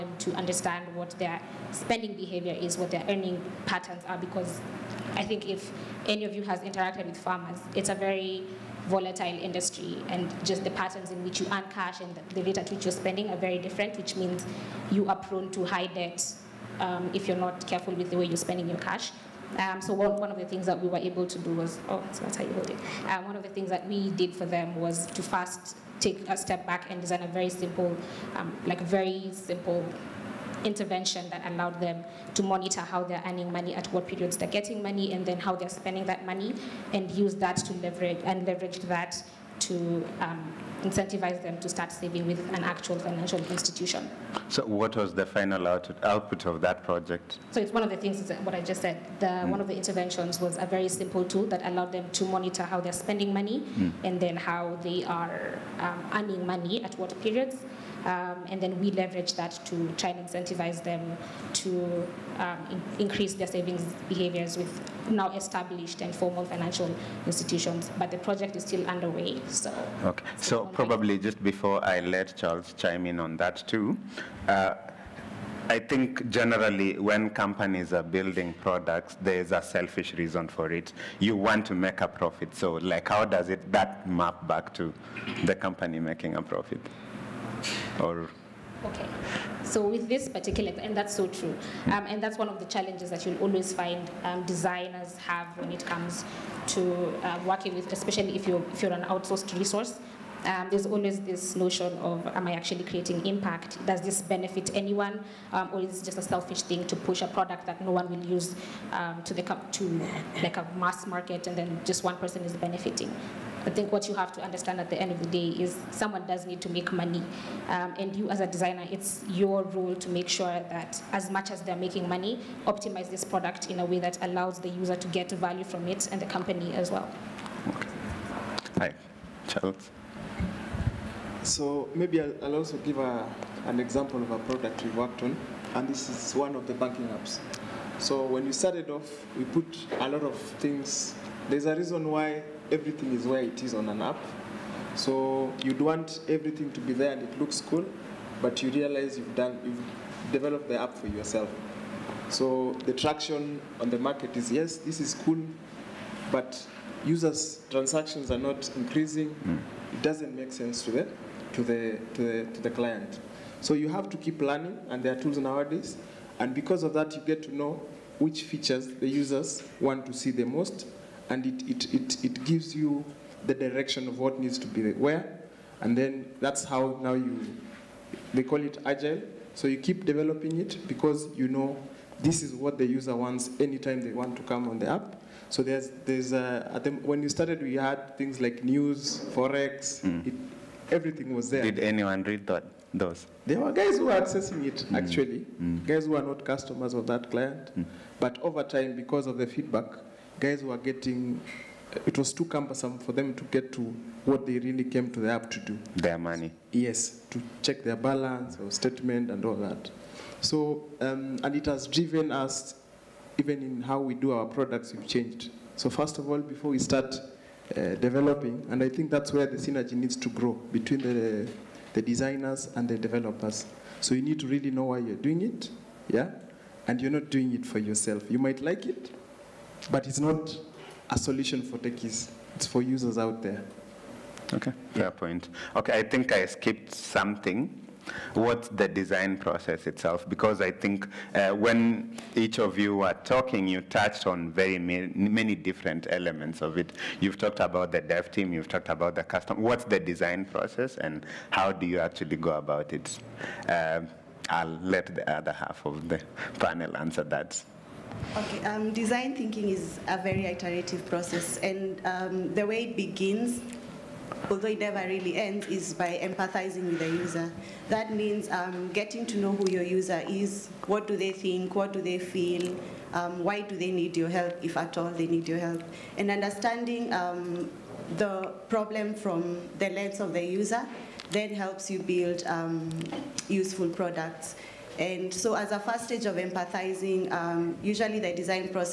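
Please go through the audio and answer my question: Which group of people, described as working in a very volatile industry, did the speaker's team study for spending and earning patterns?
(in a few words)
Farmers.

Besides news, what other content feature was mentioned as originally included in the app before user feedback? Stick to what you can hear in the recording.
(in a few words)
Forex.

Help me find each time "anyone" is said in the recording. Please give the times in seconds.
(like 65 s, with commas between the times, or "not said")
104 s, 191 s.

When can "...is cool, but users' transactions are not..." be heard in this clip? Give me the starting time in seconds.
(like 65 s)
154 s.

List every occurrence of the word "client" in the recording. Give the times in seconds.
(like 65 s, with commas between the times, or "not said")
162 s, 197 s.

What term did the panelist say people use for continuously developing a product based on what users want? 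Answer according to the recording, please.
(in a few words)
Agile.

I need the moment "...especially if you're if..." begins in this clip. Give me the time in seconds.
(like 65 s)
97 s.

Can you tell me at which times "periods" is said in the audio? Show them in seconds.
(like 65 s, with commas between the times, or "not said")
34 s, 57 s.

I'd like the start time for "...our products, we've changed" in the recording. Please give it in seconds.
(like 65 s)
214 s.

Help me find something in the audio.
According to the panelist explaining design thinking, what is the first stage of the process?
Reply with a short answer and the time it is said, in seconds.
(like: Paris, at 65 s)
Empathizing with the user, at 266 s.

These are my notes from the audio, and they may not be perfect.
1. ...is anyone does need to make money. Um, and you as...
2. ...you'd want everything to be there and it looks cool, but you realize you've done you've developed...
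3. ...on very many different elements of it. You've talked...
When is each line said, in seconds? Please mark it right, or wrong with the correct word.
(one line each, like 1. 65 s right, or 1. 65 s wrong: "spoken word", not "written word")
1. 115 s wrong: "someone", not "anyone"
2. 145 s right
3. 244 s right.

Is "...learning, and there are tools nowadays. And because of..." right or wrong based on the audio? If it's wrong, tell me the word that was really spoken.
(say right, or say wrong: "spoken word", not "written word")
right.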